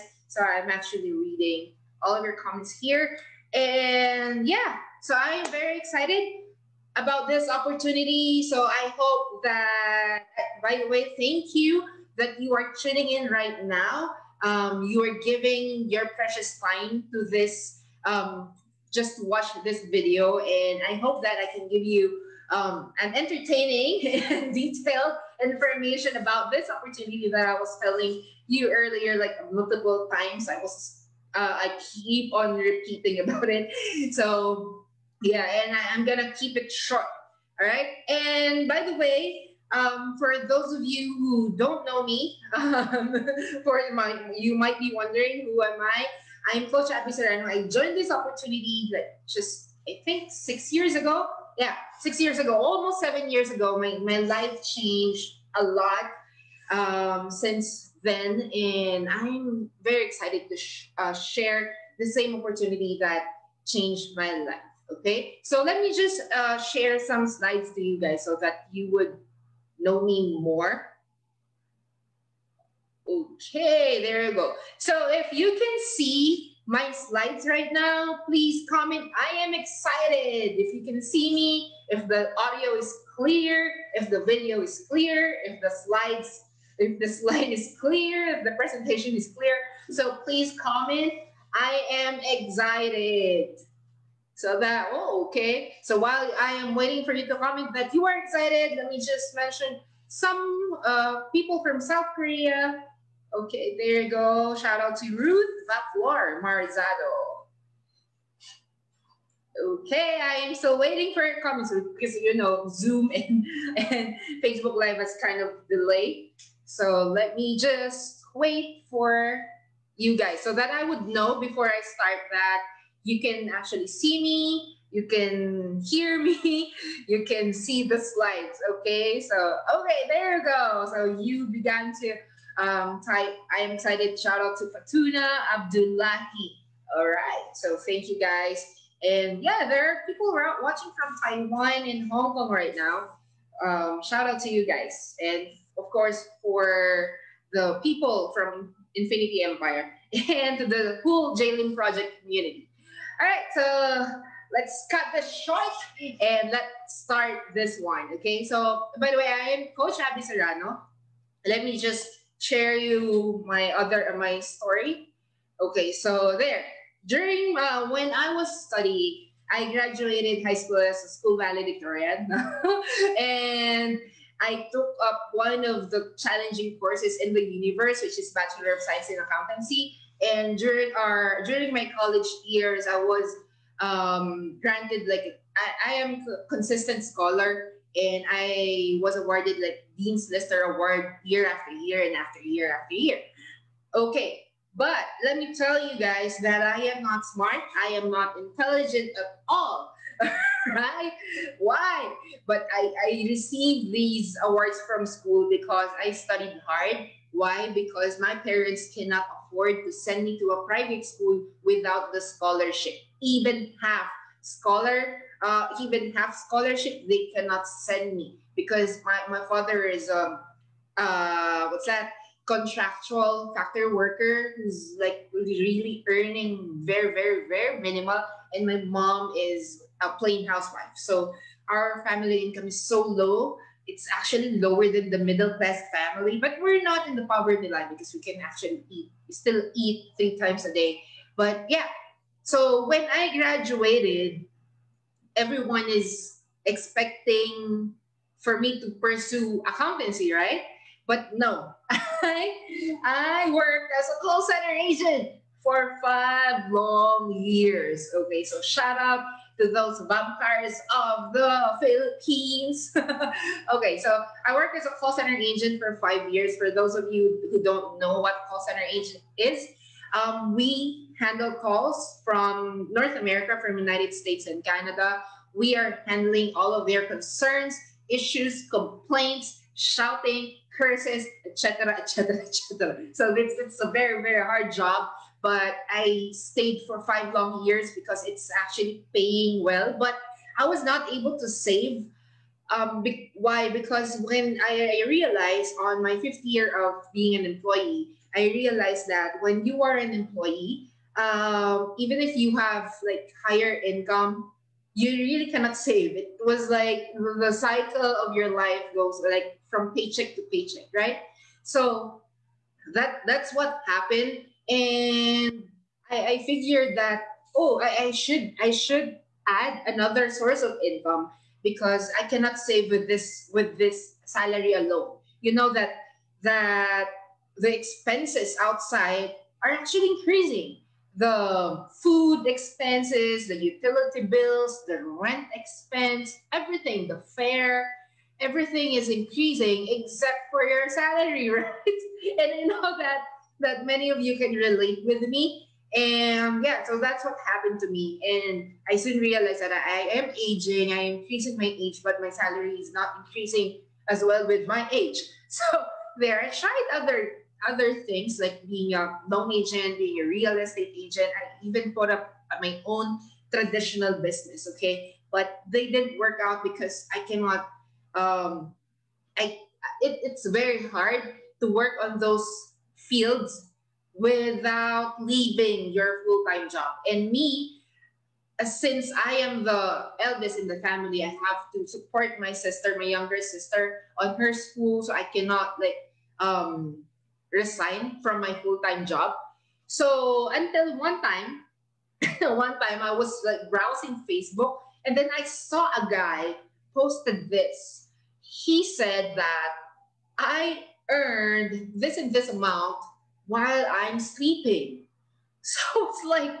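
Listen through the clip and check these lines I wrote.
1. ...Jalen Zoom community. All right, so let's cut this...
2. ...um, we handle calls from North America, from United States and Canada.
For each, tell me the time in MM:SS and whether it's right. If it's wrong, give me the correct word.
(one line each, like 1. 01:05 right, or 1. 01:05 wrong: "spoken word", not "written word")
1. 02:31 wrong: "Project", not "Zoom"
2. 04:30 right.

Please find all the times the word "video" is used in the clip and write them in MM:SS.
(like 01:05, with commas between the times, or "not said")
00:19, 01:24.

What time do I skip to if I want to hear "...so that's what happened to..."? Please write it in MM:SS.
05:46.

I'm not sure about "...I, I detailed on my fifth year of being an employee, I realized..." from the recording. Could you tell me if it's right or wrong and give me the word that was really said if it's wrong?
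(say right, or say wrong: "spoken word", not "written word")
wrong: "realized", not "detailed".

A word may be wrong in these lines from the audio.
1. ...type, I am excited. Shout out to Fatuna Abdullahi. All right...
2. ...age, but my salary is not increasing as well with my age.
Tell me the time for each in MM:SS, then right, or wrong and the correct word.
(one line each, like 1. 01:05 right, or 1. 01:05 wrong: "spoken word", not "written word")
1. 02:13 right
2. 05:51 right.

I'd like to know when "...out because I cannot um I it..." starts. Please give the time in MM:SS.
06:06.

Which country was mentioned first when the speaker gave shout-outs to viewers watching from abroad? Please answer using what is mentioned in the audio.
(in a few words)
South Korea.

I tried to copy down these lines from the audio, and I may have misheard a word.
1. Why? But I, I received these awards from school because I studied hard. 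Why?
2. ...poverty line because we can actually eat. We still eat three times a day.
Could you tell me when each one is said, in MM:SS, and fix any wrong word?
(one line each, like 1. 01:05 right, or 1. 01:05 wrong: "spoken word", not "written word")
1. 03:21 right
2. 03:57 right.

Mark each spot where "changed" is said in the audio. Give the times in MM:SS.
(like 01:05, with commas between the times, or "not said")
00:54, 01:03.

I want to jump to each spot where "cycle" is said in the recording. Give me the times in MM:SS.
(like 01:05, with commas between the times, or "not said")
05:07.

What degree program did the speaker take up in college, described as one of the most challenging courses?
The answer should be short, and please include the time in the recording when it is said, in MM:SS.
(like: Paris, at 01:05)
Bachelor of Science in Accountancy, at 02:58.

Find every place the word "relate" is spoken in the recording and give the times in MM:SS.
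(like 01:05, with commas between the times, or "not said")
05:44.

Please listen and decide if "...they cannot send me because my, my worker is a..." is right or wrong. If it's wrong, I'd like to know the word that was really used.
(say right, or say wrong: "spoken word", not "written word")
wrong: "father", not "worker".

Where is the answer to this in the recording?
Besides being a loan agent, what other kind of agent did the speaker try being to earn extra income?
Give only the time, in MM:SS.
06:00.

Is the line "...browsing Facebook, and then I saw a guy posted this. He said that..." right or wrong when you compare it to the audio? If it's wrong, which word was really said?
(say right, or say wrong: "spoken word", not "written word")
right.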